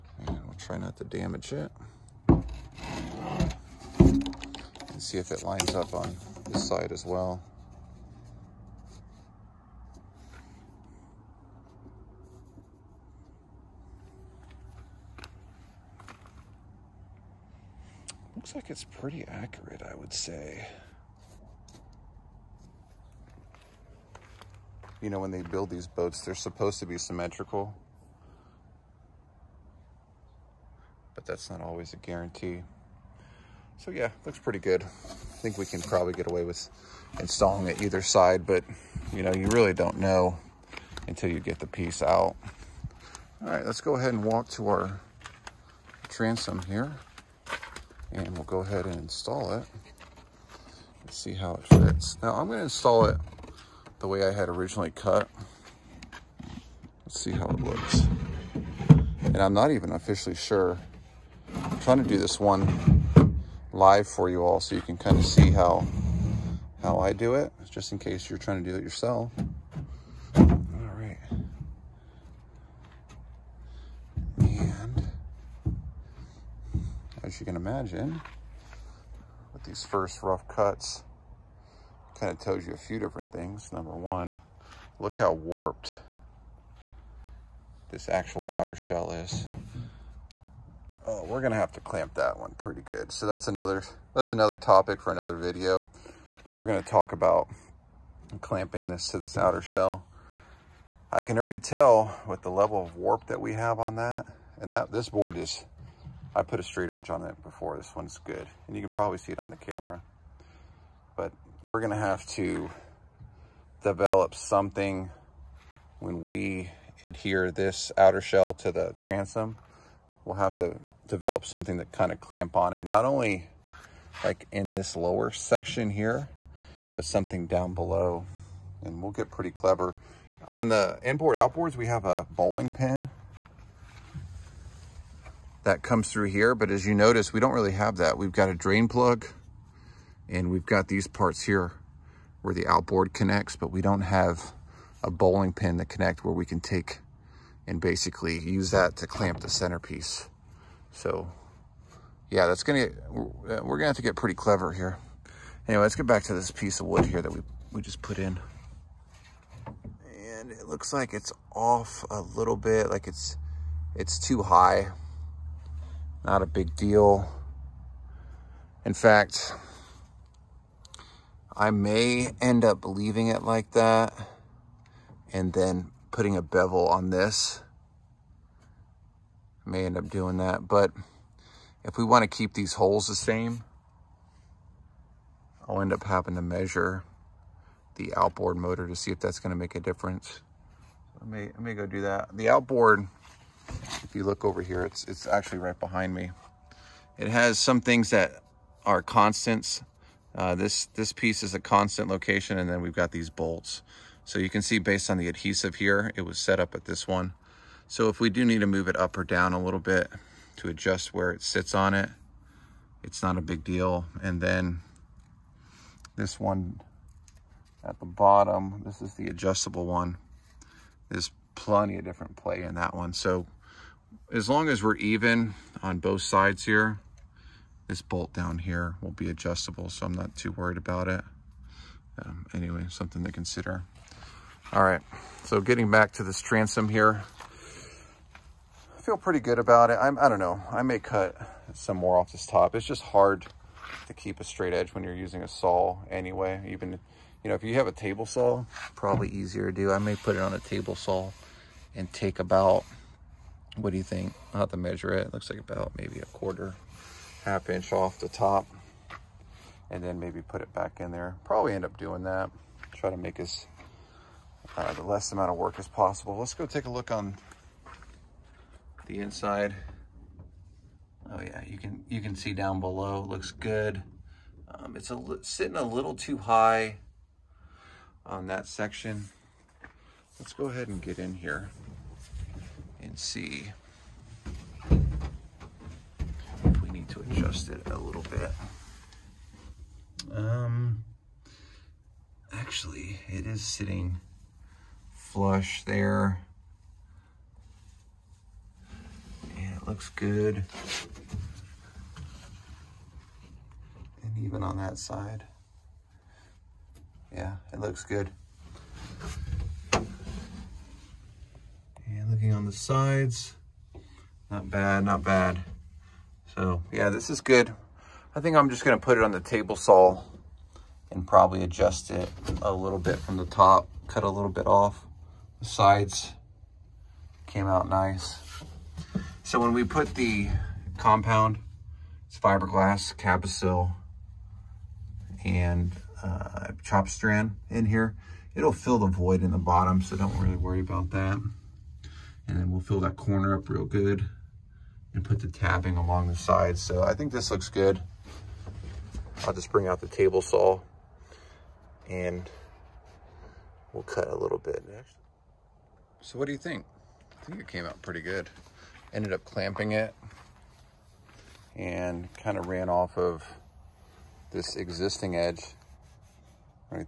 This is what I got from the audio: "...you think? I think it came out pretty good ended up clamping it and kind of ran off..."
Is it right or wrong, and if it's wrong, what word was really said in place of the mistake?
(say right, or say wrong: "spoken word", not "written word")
right.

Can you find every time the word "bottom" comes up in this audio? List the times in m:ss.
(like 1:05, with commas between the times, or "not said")
3:38, 5:39.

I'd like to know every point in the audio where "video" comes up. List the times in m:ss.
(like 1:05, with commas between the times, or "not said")
1:35.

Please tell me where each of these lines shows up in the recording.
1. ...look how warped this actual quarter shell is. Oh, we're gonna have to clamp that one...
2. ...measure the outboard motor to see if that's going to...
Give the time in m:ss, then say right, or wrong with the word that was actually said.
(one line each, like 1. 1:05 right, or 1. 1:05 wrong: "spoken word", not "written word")
1. 1:24 wrong: "outer", not "quarter"
2. 3:06 right.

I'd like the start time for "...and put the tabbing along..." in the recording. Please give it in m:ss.
5:45.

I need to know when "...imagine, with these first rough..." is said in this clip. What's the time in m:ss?
1:17.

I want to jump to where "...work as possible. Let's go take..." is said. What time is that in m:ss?
4:25.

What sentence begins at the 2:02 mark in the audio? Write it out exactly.
Not only like in this lower section here, but something down below.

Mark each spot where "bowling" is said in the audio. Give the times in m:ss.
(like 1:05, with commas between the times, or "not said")
2:12, 2:25.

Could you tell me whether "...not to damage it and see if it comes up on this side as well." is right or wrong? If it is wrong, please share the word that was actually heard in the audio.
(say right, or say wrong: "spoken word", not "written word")
wrong: "lines", not "comes".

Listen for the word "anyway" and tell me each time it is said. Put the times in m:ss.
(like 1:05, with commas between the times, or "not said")
2:35, 3:52, 4:06.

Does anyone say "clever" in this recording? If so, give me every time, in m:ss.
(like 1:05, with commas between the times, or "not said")
2:09, 2:34.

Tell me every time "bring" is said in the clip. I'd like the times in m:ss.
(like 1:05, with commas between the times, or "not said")
5:49.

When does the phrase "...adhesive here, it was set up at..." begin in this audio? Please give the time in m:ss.
3:25.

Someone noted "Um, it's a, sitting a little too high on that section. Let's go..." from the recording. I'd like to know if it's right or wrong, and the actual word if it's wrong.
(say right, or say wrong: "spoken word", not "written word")
right.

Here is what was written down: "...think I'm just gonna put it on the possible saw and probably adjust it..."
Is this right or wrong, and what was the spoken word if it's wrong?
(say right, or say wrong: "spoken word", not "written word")
wrong: "table", not "possible".